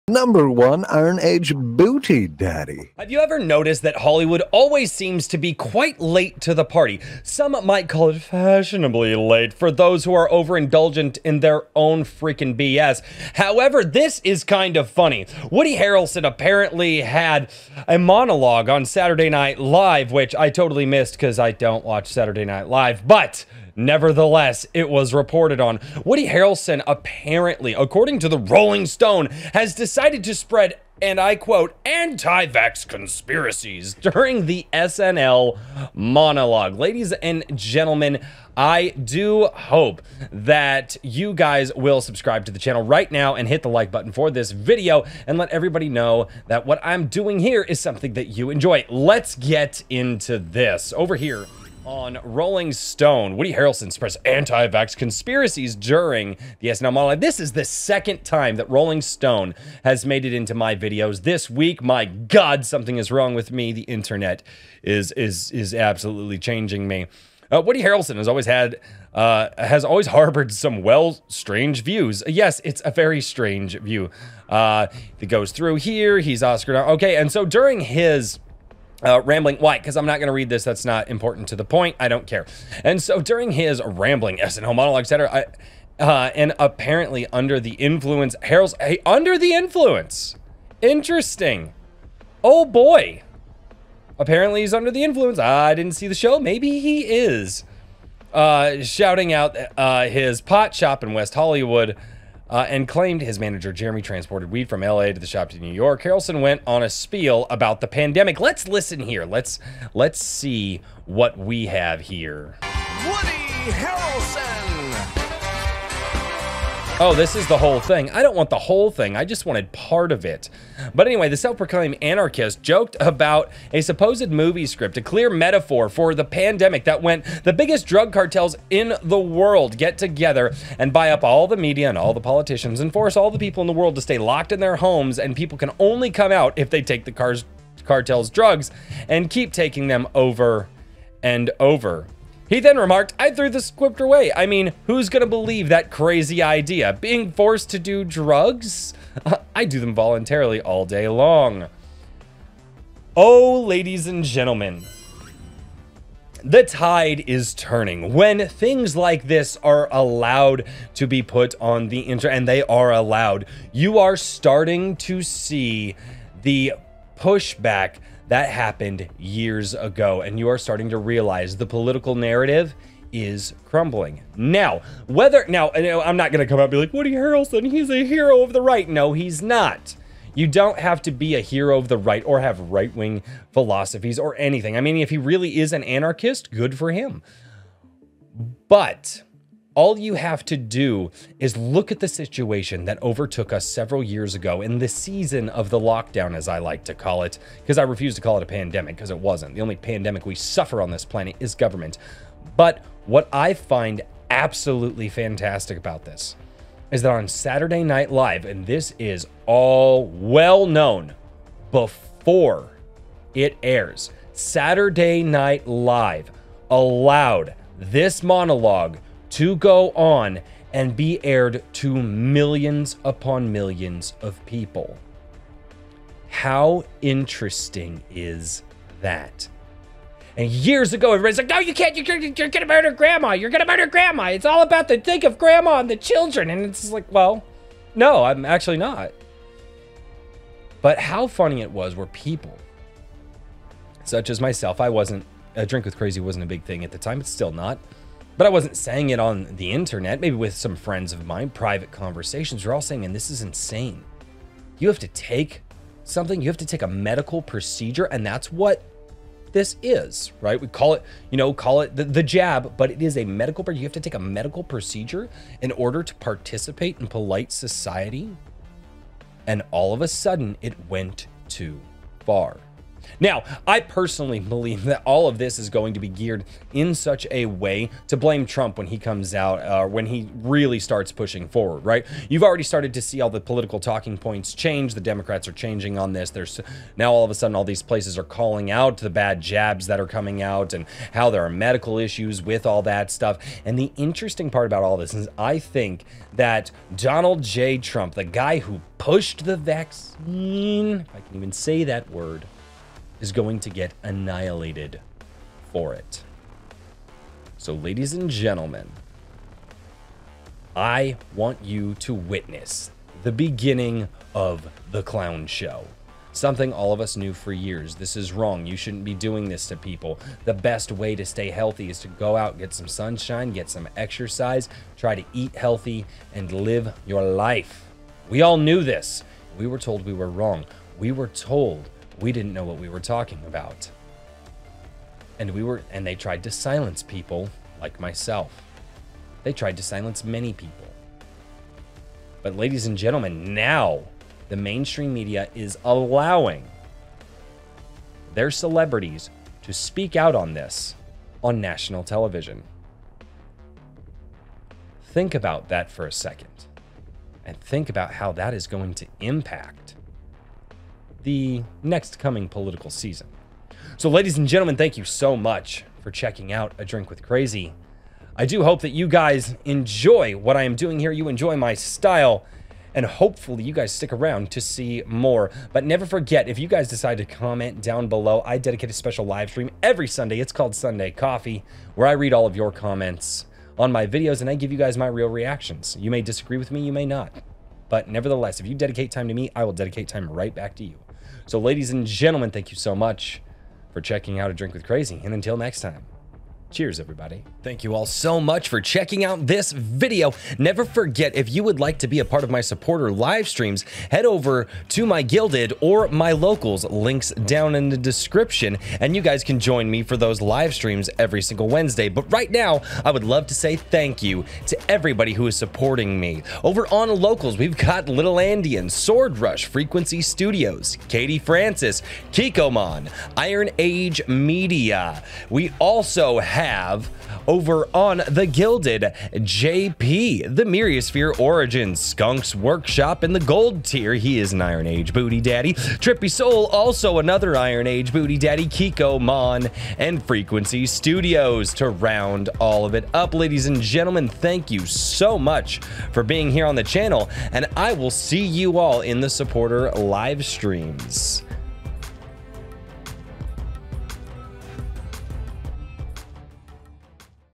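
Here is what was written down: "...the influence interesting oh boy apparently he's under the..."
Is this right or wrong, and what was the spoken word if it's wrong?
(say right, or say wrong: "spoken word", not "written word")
right.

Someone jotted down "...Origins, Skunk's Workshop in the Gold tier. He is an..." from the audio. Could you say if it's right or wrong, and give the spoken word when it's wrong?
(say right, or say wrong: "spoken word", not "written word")
right.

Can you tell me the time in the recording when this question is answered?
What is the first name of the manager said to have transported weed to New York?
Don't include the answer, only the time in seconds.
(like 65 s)
103 s.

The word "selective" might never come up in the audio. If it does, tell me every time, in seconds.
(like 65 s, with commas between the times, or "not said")
not said.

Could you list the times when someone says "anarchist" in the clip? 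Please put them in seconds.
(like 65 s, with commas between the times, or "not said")
121 s, 185 s.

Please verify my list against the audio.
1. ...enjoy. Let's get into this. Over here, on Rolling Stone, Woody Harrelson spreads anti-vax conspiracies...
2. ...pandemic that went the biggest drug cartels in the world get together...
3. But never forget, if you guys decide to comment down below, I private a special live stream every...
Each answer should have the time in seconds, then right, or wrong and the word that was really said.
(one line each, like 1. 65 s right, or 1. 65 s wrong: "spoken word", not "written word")
1. 48 s right
2. 126 s right
3. 375 s wrong: "dedicate", not "private".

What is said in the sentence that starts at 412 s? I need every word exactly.
But right now, I would love to say thank you to everybody who is supporting me.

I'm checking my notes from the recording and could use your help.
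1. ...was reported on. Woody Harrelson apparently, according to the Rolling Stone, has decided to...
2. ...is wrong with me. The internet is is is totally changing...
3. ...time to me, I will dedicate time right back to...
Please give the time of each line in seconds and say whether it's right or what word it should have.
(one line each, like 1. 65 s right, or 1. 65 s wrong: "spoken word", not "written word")
1. 24 s right
2. 62 s wrong: "absolutely", not "totally"
3. 389 s right.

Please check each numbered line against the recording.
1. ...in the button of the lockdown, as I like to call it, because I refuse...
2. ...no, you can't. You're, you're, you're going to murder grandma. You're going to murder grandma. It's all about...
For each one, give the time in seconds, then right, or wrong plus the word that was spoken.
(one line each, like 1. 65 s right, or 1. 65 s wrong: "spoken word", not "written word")
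1. 194 s wrong: "season", not "button"
2. 231 s right.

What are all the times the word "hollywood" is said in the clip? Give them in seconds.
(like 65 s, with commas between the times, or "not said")
3 s, 101 s.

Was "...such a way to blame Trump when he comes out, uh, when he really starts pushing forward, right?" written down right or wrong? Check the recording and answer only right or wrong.
right.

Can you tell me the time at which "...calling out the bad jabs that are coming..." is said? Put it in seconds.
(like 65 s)
288 s.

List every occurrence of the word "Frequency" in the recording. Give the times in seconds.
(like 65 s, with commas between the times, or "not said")
419 s, 440 s.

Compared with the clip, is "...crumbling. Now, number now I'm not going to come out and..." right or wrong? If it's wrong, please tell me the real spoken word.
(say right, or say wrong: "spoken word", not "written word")
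wrong: "whether", not "number".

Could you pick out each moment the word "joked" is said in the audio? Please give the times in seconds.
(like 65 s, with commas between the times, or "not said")
122 s.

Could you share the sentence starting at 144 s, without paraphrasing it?
I mean, who's gonna believe that crazy idea?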